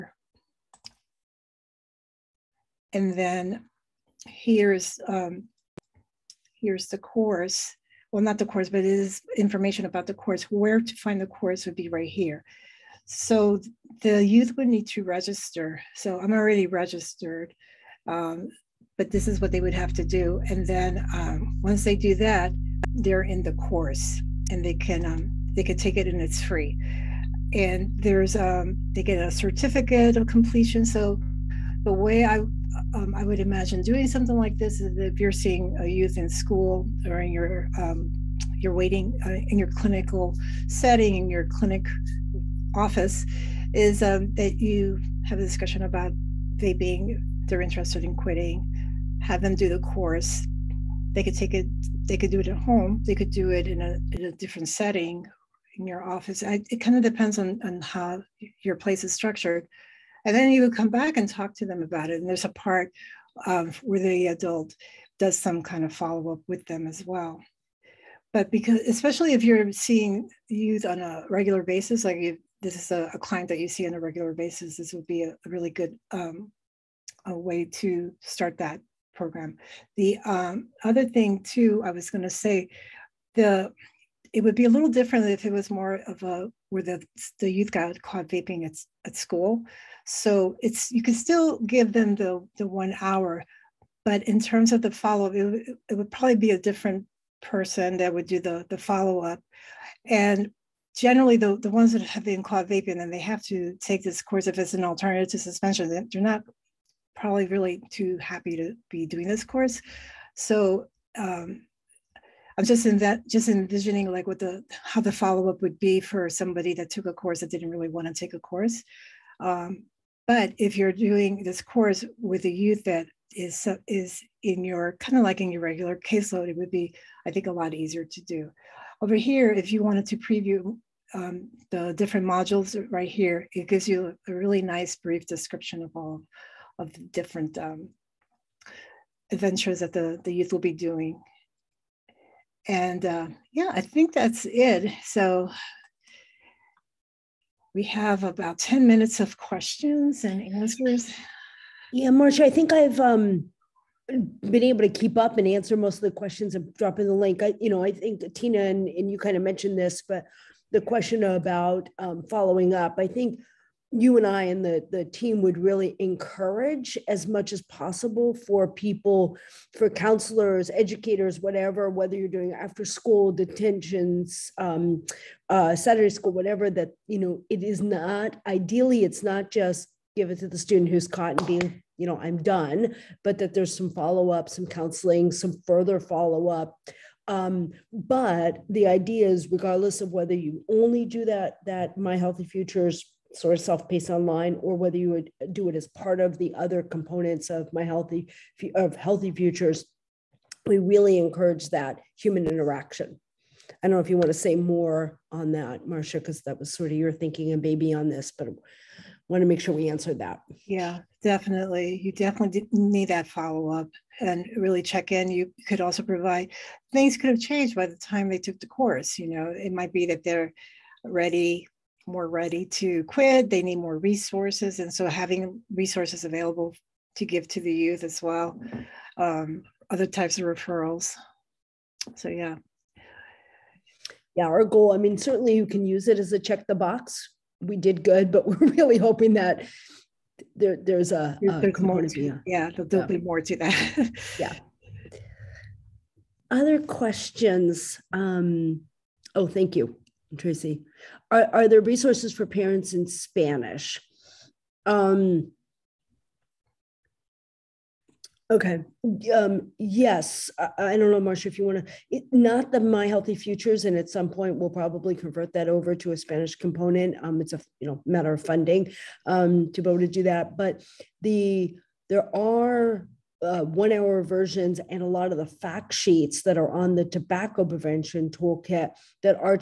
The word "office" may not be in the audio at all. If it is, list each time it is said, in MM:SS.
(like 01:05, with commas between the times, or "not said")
00:42, 00:56.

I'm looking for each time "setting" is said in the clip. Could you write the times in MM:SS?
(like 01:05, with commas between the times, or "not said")
00:40, 00:54.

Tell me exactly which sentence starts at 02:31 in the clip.
Yeah, Marcia, I think I've um, been able to keep up and answer most of the questions I'm dropping the link.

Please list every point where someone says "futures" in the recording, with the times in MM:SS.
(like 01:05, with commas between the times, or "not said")
03:12, 03:19, 04:23.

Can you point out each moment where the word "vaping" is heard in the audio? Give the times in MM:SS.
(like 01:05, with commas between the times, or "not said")
01:28, 01:42.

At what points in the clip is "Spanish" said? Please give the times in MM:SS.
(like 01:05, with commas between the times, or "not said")
04:13, 04:26.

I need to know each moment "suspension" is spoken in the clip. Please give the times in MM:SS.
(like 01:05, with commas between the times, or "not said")
01:45.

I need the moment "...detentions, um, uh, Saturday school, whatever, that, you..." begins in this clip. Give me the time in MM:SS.
02:53.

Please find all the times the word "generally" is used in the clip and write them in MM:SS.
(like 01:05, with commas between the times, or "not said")
01:40.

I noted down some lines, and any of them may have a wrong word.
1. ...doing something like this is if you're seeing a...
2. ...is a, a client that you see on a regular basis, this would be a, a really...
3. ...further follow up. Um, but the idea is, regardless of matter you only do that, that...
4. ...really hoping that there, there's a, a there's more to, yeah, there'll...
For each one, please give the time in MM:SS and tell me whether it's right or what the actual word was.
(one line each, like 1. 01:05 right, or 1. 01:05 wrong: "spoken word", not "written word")
1. 00:33 right
2. 01:12 right
3. 03:05 wrong: "whether", not "matter"
4. 03:58 right.